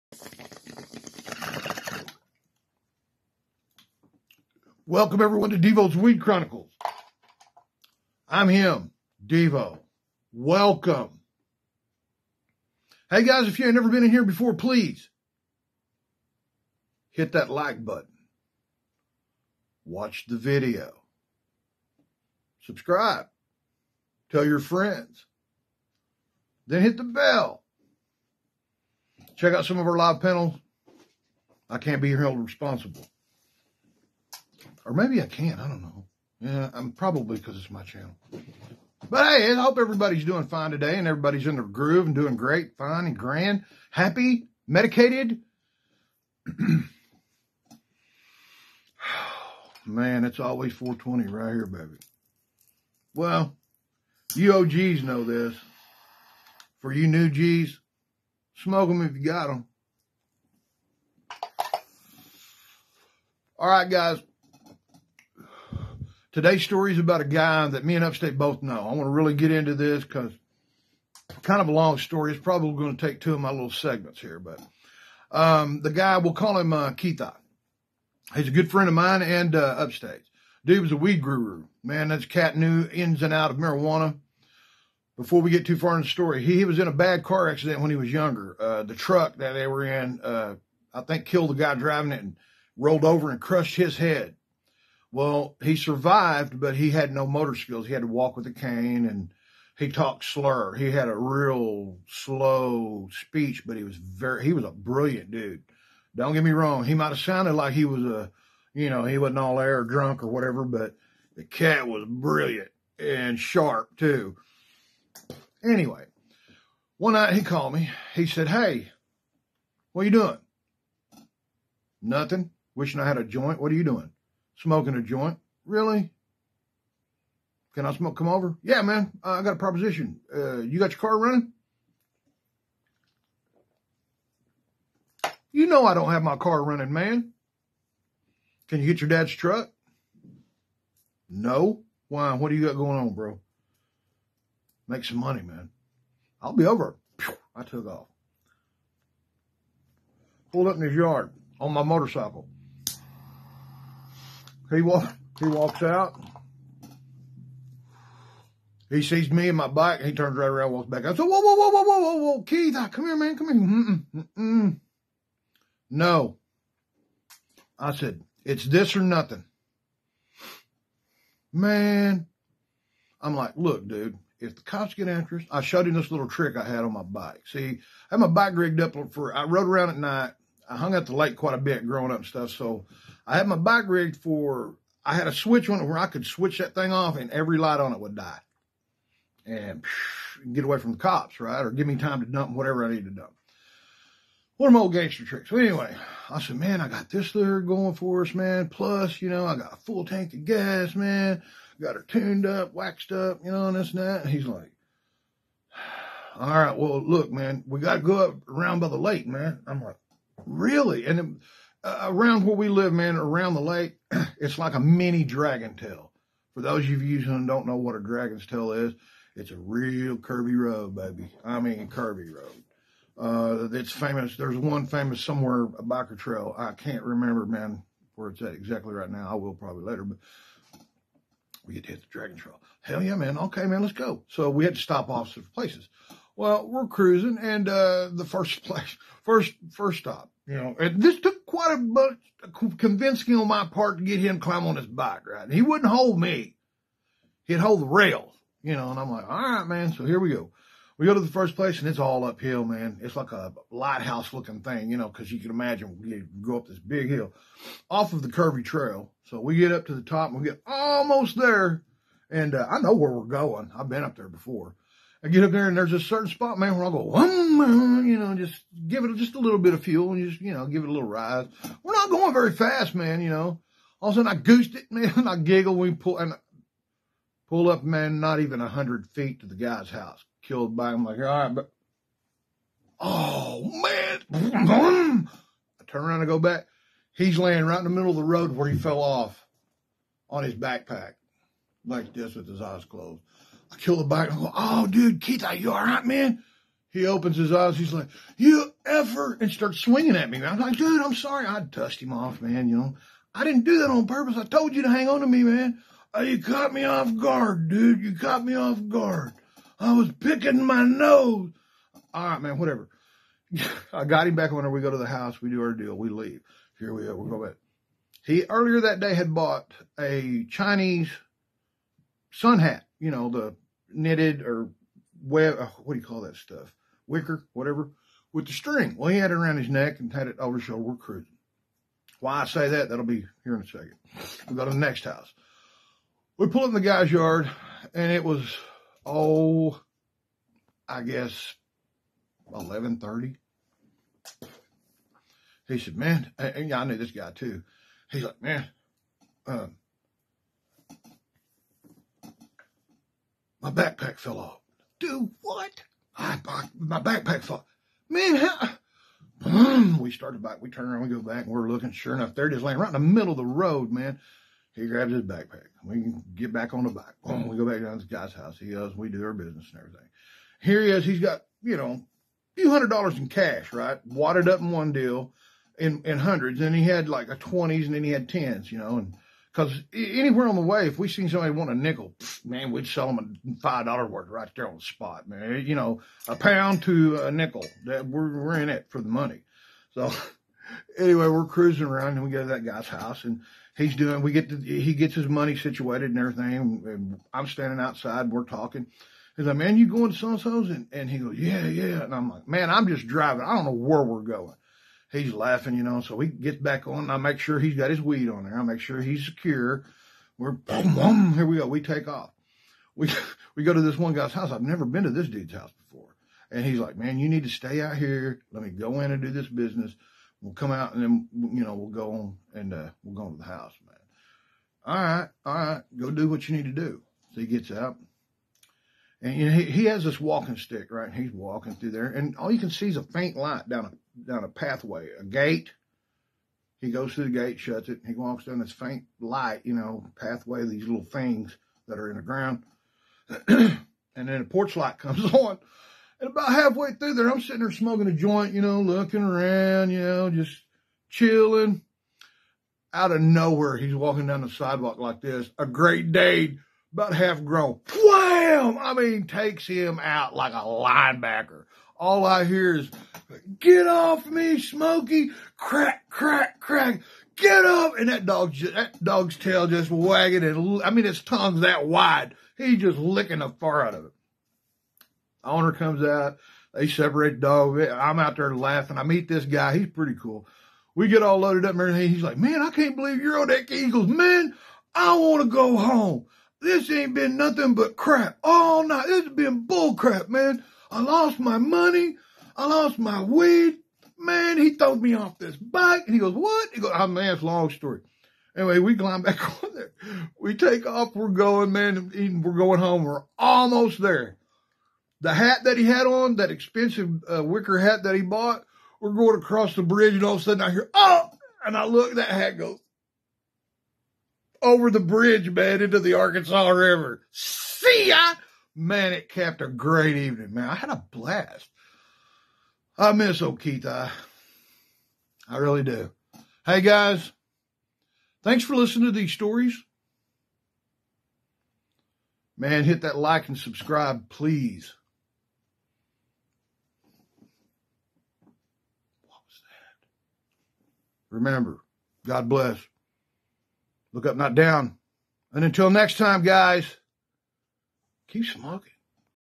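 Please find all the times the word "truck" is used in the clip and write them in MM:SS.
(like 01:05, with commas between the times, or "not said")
01:28, 02:19.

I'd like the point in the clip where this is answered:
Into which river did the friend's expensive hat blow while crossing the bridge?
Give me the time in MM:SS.
08:36.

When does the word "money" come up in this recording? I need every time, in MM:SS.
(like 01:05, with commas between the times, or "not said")
02:25, 06:29, 06:35, 08:11.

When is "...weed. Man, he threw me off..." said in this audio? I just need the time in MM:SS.
08:13.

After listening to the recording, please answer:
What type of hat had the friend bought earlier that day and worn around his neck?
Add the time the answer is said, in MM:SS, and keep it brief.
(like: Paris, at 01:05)
Chinese sun hat, at 05:20.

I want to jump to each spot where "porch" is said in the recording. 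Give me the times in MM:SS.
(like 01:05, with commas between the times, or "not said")
07:24.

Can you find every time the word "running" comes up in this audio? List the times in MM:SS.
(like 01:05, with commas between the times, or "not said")
02:11, 02:16.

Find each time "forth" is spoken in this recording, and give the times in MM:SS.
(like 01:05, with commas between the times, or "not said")
not said.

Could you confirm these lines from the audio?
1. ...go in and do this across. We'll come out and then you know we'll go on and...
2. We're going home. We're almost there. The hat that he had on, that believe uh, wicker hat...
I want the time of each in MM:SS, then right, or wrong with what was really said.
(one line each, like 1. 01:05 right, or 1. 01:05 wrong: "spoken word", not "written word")
1. 06:58 wrong: "business", not "across"
2. 08:22 wrong: "expensive", not "believe".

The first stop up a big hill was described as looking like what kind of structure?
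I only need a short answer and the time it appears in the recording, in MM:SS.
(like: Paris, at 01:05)
lighthouse, at 04:13.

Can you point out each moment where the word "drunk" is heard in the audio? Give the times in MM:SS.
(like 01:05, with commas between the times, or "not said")
01:49.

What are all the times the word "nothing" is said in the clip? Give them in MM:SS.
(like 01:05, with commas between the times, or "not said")
02:02, 02:49, 08:07.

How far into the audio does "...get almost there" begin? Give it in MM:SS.
04:20.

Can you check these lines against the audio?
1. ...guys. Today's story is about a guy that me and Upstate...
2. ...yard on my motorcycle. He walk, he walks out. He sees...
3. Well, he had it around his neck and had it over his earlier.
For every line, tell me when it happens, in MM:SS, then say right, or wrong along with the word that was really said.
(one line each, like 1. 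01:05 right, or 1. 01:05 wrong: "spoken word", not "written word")
1. 01:03 right
2. 02:30 right
3. 05:28 wrong: "shoulder", not "earlier".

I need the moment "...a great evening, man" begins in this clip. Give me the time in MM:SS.
08:39.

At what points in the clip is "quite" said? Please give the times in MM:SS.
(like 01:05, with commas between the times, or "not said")
03:01, 04:01.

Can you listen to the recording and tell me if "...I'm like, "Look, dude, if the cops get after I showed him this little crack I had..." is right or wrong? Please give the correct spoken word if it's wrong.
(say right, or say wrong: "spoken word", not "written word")
wrong: "trick", not "crack".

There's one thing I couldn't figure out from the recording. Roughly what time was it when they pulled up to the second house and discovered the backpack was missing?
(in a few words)
11:30.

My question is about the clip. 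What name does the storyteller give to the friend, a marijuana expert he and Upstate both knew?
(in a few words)
Keitha.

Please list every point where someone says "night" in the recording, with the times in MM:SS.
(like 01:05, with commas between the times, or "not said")
01:57, 02:59, 08:08.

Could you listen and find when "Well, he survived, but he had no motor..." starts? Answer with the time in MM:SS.
01:35.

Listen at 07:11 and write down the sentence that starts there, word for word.
He's walking through there, and all you can see is a faint light down down a pathway, a gate.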